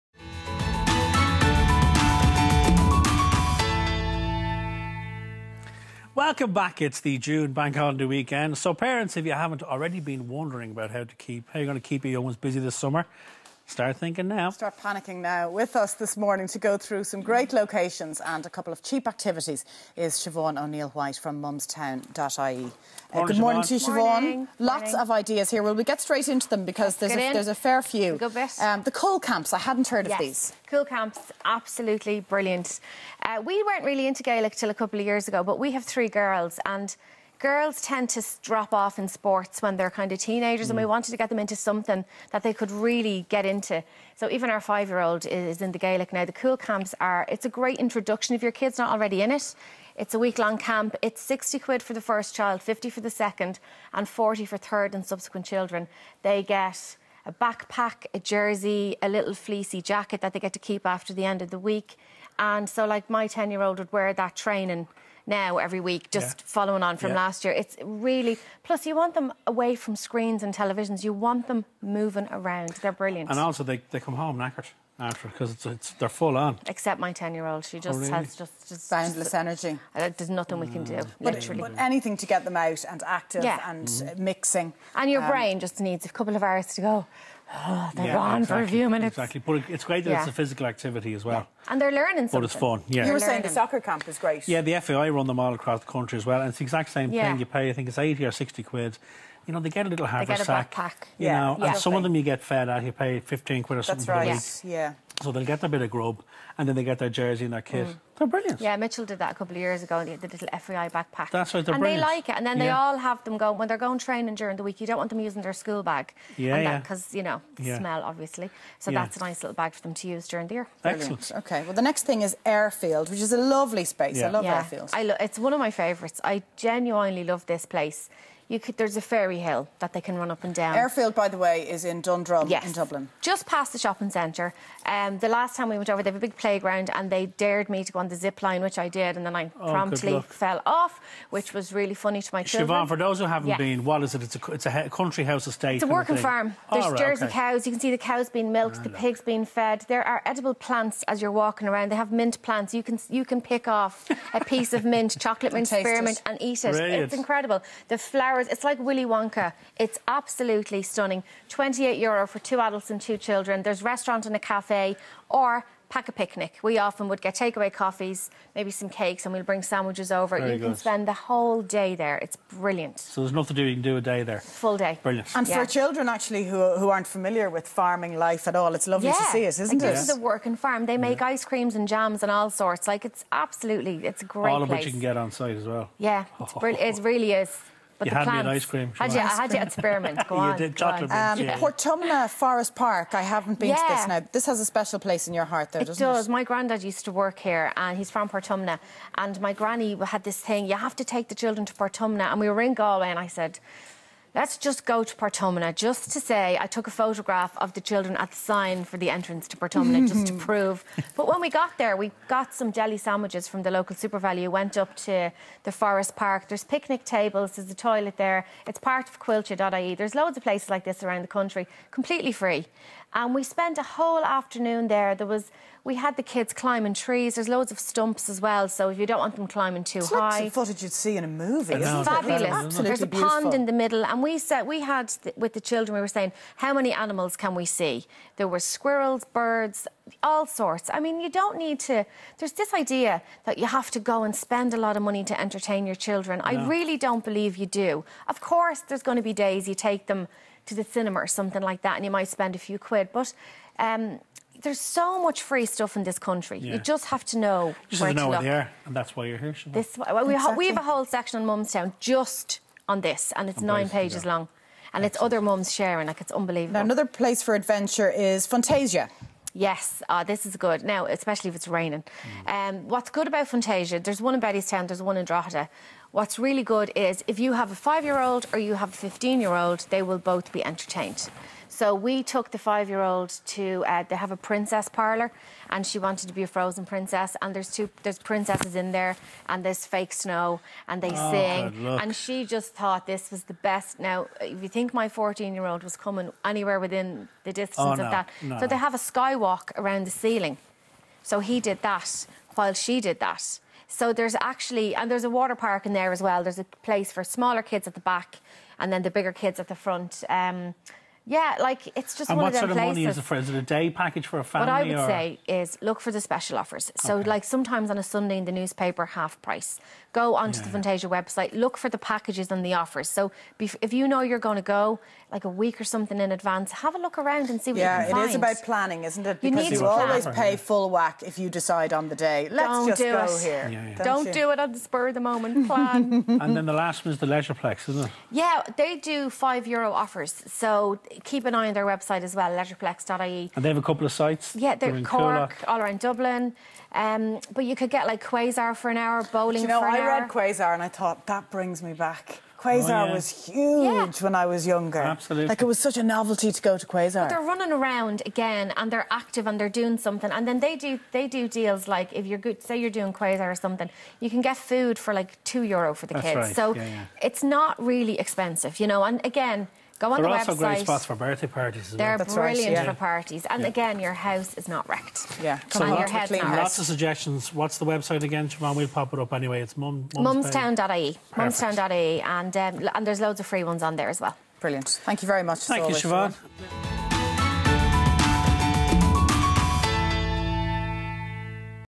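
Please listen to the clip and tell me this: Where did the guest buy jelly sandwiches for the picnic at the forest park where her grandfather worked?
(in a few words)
SuperValu.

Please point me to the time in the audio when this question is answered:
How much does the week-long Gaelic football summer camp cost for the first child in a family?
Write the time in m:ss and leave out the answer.
0:51.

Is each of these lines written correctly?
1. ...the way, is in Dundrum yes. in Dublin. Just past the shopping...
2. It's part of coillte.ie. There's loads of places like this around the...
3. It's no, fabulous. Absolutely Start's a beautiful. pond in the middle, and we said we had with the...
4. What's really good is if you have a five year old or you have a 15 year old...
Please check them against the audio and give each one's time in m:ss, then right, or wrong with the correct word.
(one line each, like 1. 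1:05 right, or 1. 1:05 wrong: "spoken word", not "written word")
1. 2:11 right
2. 3:38 right
3. 3:51 wrong: "There", not "Start"
4. 4:36 right.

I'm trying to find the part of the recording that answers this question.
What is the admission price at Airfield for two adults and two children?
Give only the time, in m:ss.
2:41.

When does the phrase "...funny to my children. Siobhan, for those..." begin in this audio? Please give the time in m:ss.
2:21.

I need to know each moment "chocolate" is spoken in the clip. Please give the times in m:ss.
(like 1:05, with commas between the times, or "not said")
2:35, 3:10.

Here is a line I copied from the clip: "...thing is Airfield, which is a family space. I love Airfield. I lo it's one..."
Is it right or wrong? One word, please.
wrong.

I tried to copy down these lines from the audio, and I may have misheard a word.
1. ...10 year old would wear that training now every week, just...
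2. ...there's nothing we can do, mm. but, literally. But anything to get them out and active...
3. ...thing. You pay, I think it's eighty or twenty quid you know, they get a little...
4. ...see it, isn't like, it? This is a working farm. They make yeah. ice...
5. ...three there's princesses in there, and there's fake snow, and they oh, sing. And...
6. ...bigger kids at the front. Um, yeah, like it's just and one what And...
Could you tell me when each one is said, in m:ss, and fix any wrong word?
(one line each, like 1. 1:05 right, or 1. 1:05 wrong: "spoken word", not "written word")
1. 1:03 right
2. 1:20 right
3. 1:37 wrong: "sixty", not "twenty"
4. 2:59 right
5. 4:47 wrong: "two", not "three"
6. 5:09 right.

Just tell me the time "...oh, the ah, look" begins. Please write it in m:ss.
2:28.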